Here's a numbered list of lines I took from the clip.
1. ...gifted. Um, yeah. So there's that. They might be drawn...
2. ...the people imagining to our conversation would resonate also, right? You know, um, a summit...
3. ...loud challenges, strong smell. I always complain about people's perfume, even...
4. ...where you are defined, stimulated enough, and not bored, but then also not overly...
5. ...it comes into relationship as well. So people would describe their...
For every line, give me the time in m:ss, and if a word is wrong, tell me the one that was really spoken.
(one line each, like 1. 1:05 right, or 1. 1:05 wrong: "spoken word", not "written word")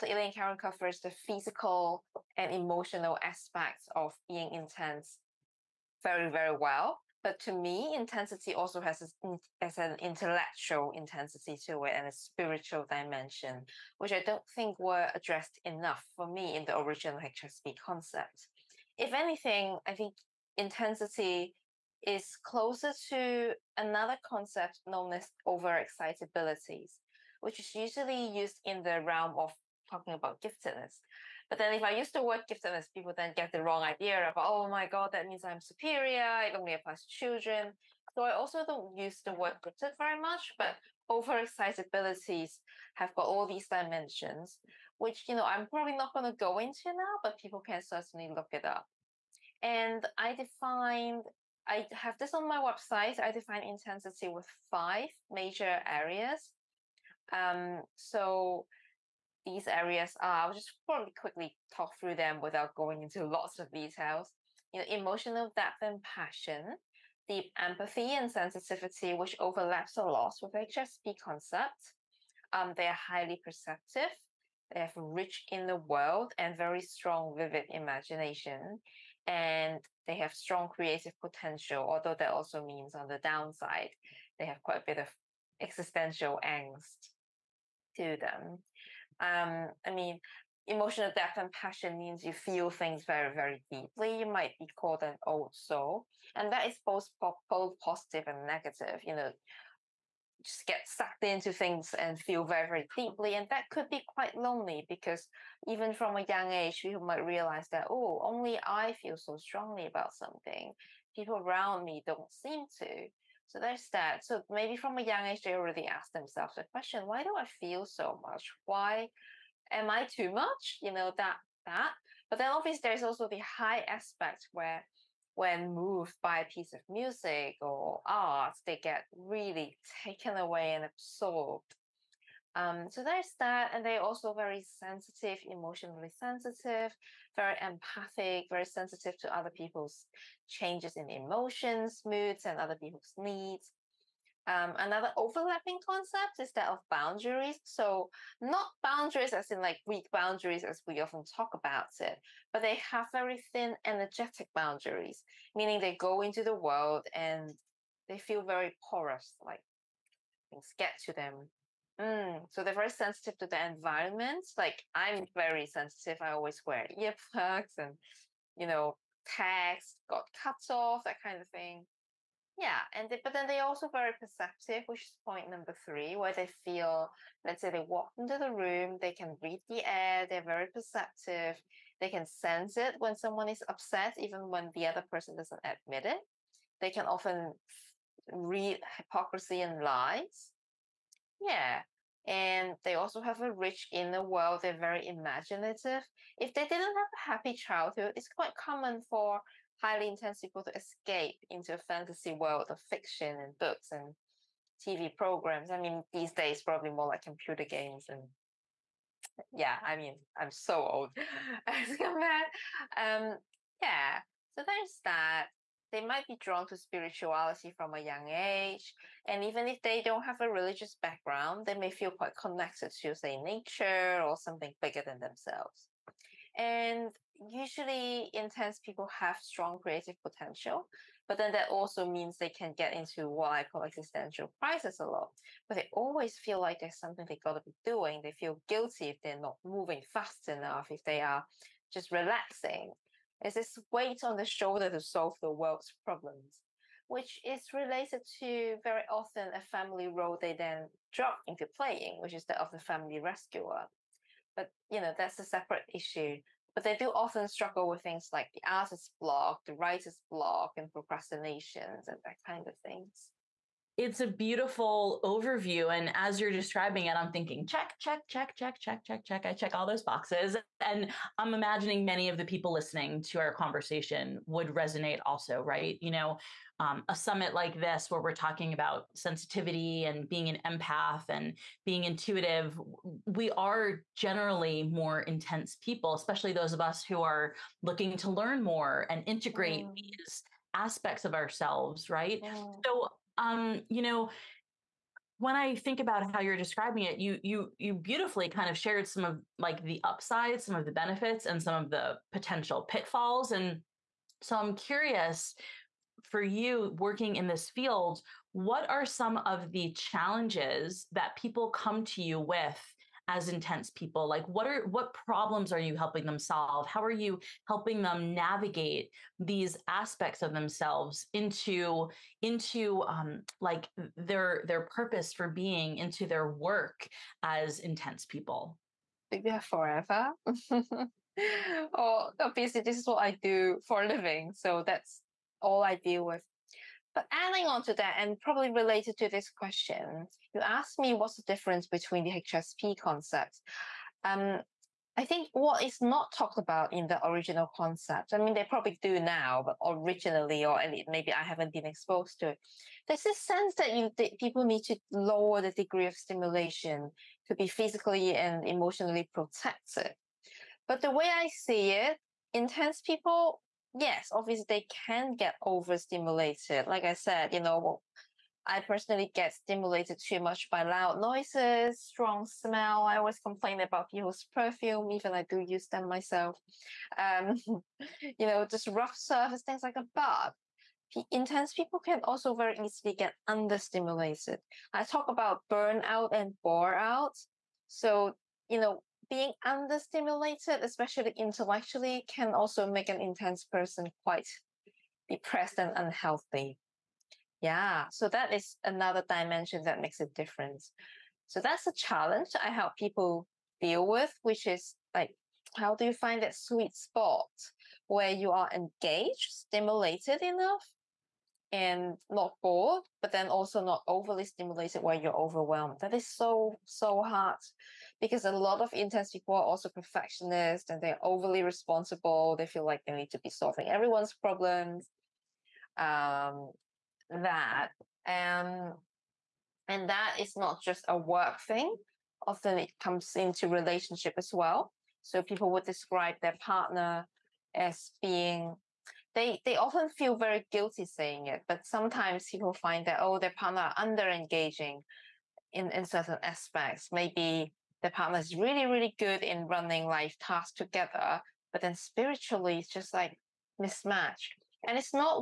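1. 3:31 wrong: "compared", not "gifted"
2. 4:32 wrong: "listening", not "imagining"
3. 6:10 wrong: "noises", not "challenges"
4. 6:48 wrong: "engaged", not "defined"
5. 7:12 right.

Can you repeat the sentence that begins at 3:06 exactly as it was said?
They can often read hypocrisy and lies.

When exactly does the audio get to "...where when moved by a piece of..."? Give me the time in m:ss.
2:04.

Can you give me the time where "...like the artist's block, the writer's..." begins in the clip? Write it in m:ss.
4:18.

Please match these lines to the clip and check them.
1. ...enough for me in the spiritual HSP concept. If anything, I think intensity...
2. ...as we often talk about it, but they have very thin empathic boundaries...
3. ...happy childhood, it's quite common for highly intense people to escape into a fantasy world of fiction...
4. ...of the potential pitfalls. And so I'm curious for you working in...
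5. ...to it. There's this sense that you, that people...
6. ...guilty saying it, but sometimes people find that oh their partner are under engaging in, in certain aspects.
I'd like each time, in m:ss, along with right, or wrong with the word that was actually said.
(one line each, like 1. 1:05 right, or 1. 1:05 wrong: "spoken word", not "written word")
1. 0:15 wrong: "original", not "spiritual"
2. 2:30 wrong: "energetic", not "empathic"
3. 3:17 right
4. 5:01 right
5. 5:52 right
6. 7:20 right.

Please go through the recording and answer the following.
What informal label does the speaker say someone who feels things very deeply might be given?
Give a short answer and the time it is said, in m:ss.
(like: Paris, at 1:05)
Old soul, at 1:35.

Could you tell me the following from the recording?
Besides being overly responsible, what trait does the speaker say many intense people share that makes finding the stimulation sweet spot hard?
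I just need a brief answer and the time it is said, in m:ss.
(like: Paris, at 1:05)
Perfectionists, at 6:59.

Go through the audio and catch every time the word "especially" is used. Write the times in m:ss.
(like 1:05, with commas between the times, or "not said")
4:46, 6:30.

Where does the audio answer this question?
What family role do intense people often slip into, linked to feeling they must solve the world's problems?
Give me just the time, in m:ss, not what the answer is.
4:12.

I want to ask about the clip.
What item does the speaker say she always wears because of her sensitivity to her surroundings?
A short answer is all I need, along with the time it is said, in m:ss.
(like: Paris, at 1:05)
Earplugs, at 2:46.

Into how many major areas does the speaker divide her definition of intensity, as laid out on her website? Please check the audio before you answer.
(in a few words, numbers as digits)
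5.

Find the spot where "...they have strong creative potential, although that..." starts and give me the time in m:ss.
1:20.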